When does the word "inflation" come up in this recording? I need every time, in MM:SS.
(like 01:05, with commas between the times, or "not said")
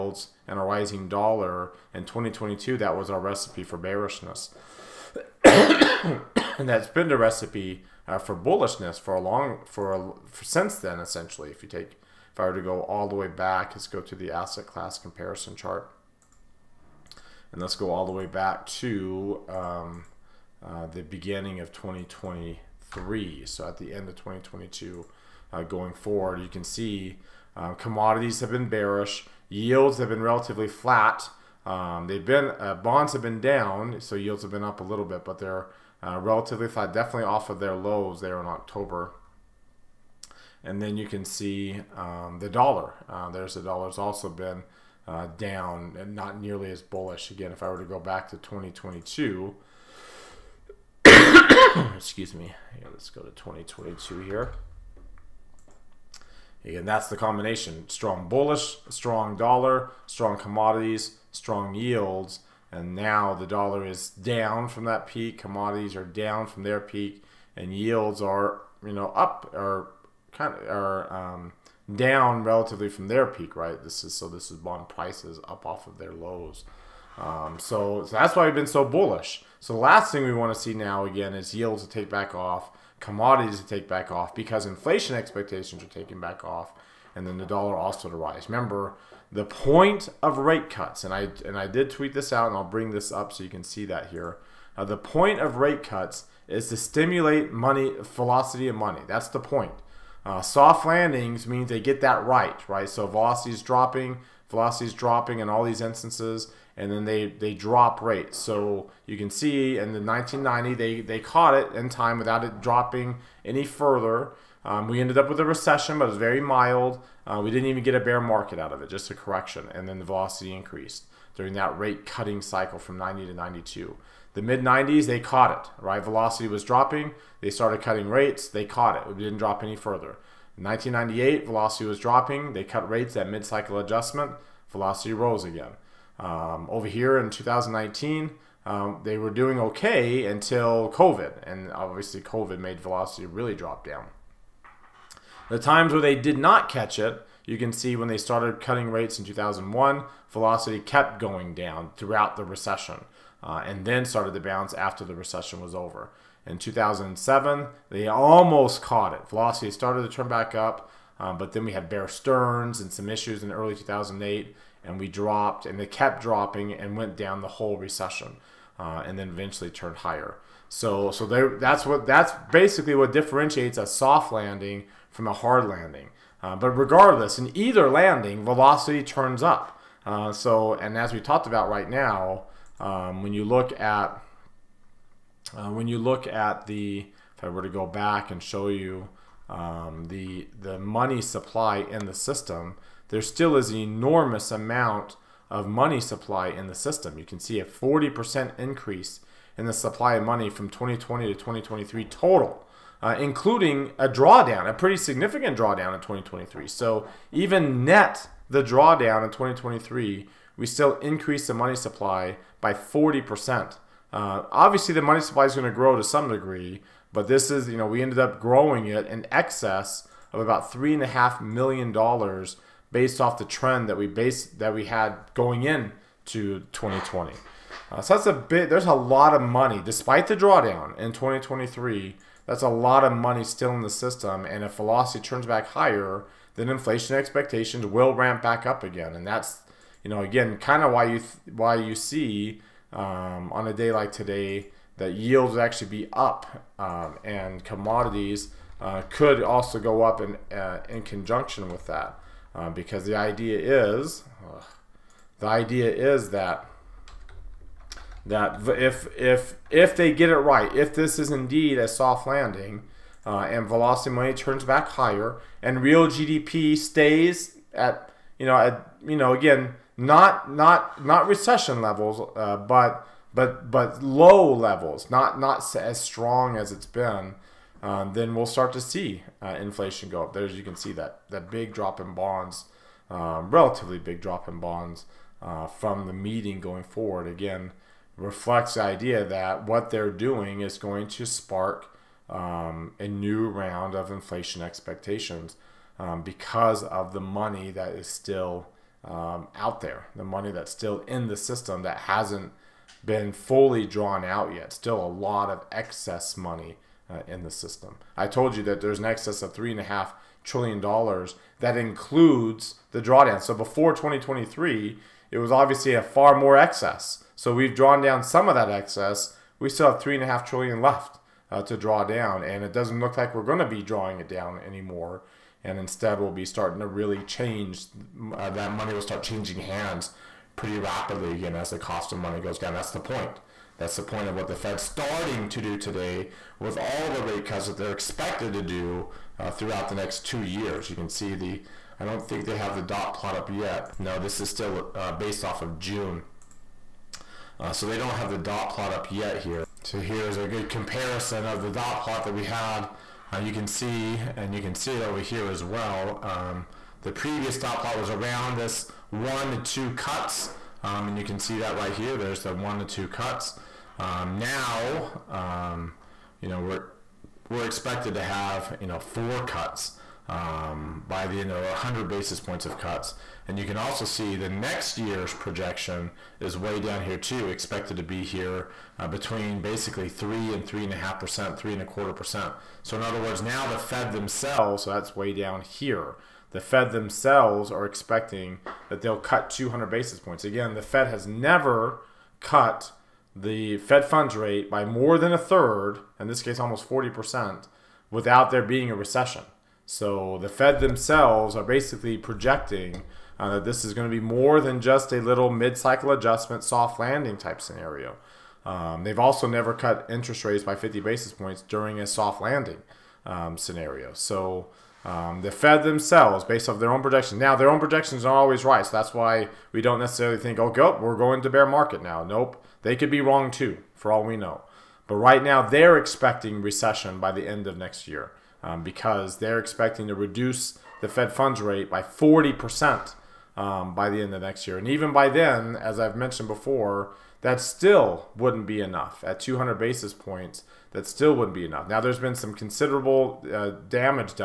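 01:24, 03:56, 04:39, 04:54.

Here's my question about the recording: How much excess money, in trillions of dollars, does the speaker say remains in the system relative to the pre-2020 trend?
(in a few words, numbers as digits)
3.5 trillion dollars.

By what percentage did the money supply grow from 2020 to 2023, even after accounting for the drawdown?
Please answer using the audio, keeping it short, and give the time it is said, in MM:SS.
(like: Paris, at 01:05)
40%, at 03:17.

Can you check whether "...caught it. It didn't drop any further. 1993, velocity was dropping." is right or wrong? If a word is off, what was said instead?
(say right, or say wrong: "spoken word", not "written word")
wrong: "1998", not "1993".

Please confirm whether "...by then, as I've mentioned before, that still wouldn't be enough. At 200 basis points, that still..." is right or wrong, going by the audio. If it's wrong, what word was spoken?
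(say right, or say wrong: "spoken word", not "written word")
right.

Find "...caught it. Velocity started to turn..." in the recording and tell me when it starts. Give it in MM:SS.
02:38.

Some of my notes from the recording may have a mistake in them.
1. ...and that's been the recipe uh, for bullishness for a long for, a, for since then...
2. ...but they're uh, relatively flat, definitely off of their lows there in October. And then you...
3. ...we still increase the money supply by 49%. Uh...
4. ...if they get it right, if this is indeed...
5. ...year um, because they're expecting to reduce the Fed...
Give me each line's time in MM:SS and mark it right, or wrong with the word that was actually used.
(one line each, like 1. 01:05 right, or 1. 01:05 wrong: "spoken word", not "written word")
1. 00:05 right
2. 00:35 right
3. 03:30 wrong: "40", not "49"
4. 04:19 right
5. 07:08 right.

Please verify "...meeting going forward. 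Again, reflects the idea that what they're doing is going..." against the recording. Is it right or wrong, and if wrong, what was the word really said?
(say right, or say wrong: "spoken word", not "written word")
right.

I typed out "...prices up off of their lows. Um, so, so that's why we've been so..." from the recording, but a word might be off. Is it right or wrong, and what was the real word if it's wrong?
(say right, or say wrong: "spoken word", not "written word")
right.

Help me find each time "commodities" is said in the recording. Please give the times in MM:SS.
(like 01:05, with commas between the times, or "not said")
00:27, 01:00, 01:05, 01:22, 04:07.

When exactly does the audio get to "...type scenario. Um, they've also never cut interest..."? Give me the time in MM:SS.
06:47.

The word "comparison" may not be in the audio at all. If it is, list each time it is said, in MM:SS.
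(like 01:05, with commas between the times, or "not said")
00:14, 05:50.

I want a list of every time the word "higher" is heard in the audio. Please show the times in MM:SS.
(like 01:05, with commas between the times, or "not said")
02:49, 03:55, 04:24.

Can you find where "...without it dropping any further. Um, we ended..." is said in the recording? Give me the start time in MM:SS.
01:52.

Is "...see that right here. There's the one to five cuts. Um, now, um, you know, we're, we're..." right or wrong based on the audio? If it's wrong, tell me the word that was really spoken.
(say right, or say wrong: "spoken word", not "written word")
wrong: "two", not "five".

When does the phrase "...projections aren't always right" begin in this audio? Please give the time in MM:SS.
06:57.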